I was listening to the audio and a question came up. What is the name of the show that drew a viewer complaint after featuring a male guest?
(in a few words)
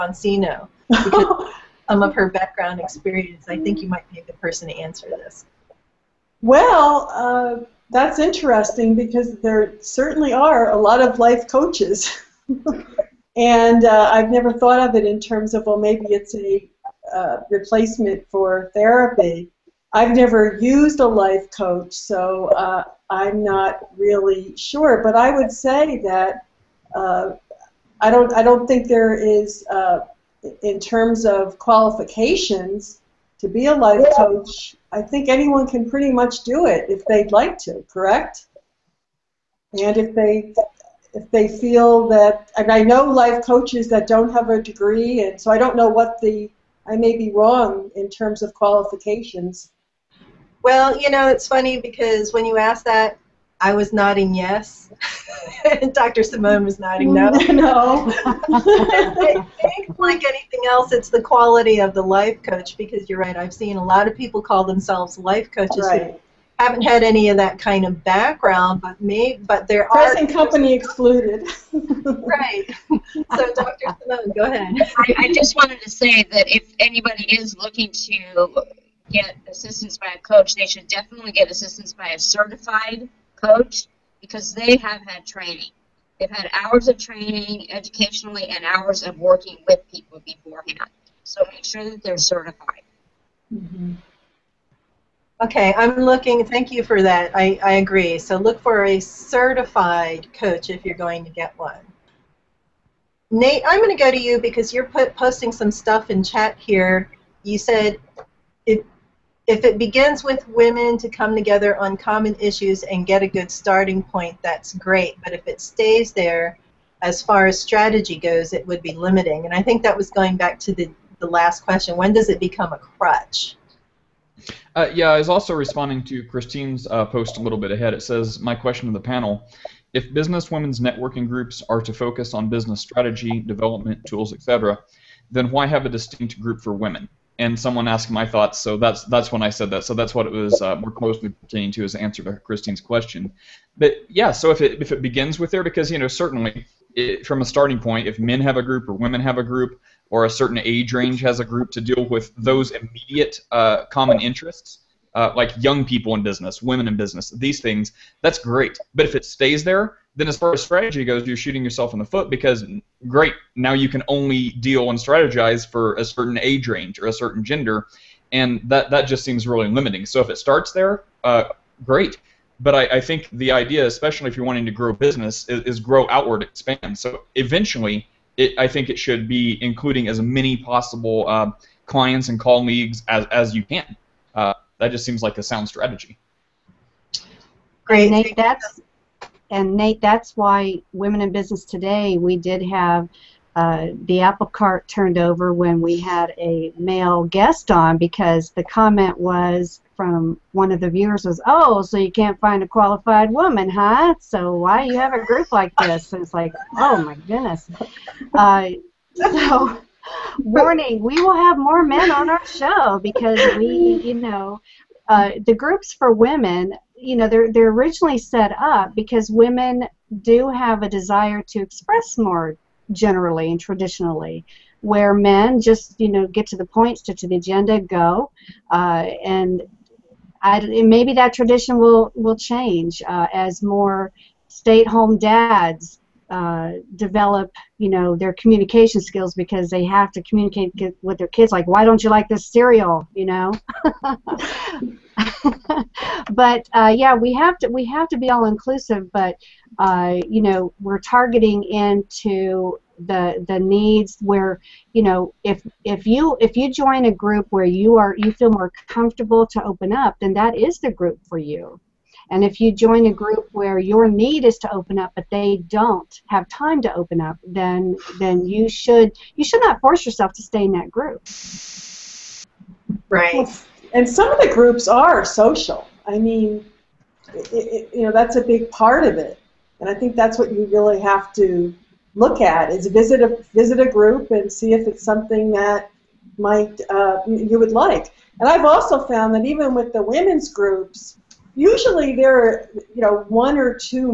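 Women in Business Today.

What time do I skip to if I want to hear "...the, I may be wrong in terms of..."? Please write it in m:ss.
0:46.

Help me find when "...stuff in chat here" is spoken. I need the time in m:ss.
1:45.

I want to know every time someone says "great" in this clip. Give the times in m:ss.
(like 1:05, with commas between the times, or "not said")
1:54, 2:38, 2:43, 2:51, 3:07.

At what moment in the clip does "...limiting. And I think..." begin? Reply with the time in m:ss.
1:58.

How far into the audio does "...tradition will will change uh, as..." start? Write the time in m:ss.
3:51.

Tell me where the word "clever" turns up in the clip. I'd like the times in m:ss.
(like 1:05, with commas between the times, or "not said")
not said.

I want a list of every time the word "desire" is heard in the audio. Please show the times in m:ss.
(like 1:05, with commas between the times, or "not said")
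3:40.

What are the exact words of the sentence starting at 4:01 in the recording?
Like, why don't you like this cereal?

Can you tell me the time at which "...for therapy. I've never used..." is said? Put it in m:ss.
0:18.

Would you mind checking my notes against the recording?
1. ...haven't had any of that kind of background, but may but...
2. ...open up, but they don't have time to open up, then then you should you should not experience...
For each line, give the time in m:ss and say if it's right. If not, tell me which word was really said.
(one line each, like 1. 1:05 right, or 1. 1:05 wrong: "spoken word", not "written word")
1. 1:06 right
2. 4:24 wrong: "force", not "experience".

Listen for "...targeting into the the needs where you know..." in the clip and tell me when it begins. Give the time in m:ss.
4:10.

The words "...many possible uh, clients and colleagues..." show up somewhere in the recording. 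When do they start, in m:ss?
3:00.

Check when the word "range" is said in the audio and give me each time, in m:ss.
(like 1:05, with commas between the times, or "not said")
2:30, 2:46.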